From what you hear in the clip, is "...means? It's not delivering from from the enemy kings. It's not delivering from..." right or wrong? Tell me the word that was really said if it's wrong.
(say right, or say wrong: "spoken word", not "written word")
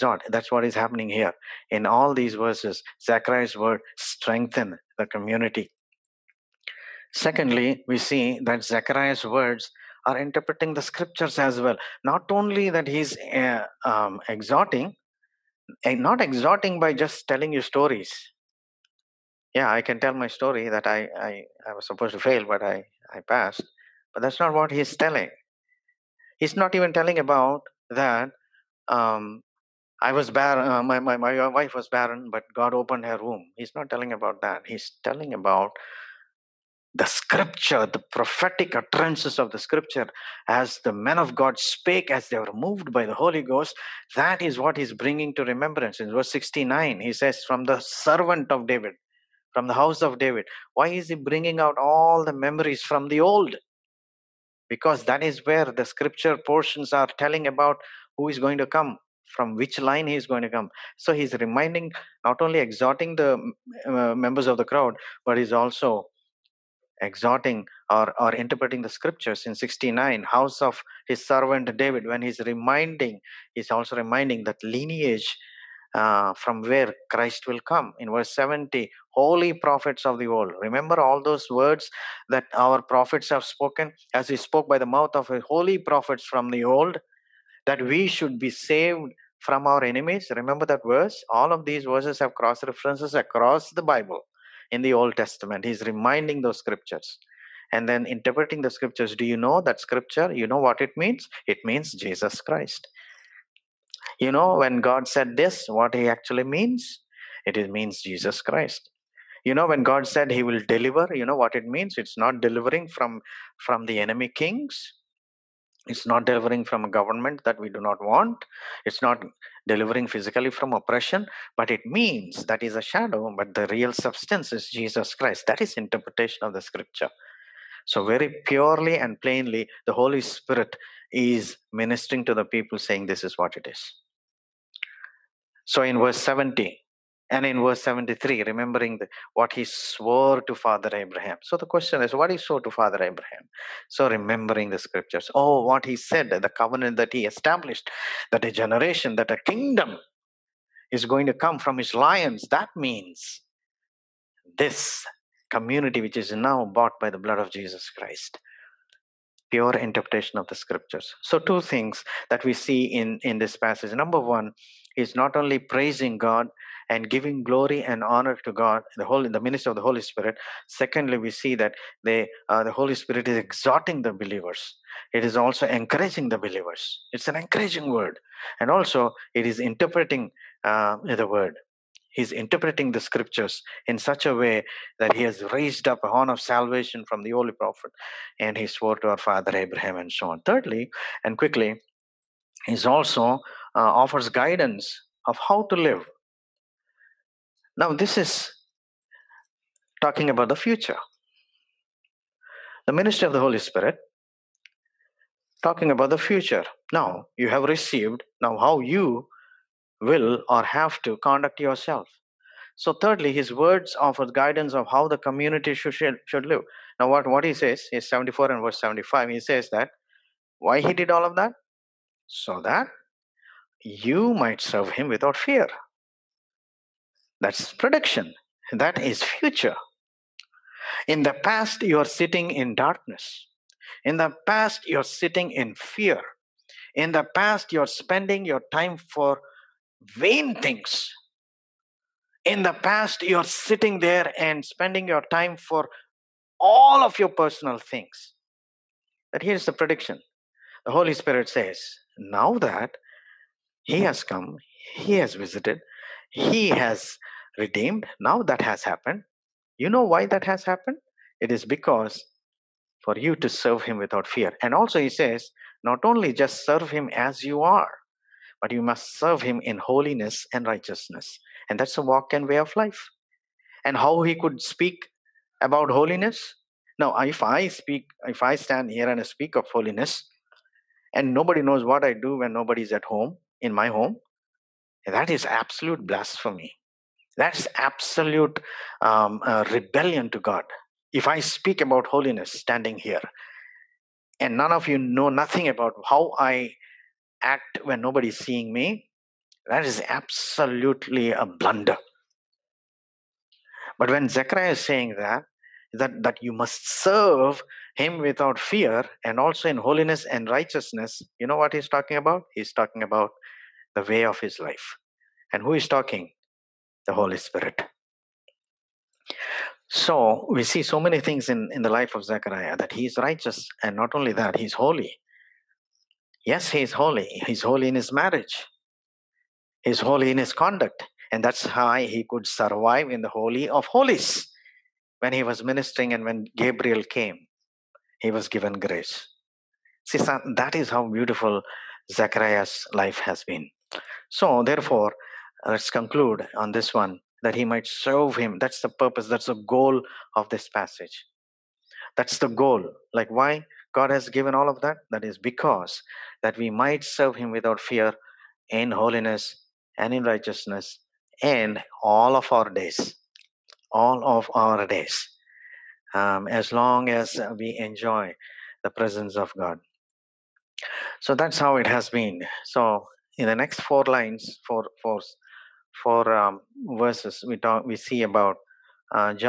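right.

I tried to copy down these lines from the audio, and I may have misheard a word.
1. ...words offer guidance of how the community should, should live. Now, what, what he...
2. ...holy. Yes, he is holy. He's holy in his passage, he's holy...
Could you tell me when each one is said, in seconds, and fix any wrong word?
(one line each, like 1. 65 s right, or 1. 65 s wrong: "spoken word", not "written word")
1. 213 s right
2. 324 s wrong: "marriage", not "passage".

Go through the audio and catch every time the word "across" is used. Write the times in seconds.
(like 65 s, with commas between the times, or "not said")
93 s.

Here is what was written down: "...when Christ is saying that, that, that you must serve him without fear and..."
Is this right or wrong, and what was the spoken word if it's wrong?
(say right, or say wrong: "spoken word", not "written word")
wrong: "Zechariah", not "Christ".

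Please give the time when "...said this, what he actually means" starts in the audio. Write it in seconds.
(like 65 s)
105 s.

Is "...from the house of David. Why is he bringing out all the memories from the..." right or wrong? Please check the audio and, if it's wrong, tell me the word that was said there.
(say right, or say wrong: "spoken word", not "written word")
right.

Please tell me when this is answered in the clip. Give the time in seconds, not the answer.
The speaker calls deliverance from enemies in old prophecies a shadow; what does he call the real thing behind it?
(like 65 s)
123 s.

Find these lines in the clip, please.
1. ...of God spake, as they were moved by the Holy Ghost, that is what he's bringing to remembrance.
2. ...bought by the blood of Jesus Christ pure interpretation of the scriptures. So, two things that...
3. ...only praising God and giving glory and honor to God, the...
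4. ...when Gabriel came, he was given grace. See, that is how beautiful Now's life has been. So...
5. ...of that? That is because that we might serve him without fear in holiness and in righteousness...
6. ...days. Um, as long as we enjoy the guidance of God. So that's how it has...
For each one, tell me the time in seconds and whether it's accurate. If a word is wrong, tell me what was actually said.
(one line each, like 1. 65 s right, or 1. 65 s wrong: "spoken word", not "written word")
1. 41 s right
2. 156 s right
3. 165 s right
4. 336 s wrong: "Zechariah", not "Now"
5. 354 s right
6. 364 s wrong: "presence", not "guidance".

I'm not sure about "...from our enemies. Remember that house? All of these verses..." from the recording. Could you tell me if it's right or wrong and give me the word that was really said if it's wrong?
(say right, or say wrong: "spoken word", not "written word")
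wrong: "verse", not "house".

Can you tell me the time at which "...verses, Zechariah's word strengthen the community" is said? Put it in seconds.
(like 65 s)
2 s.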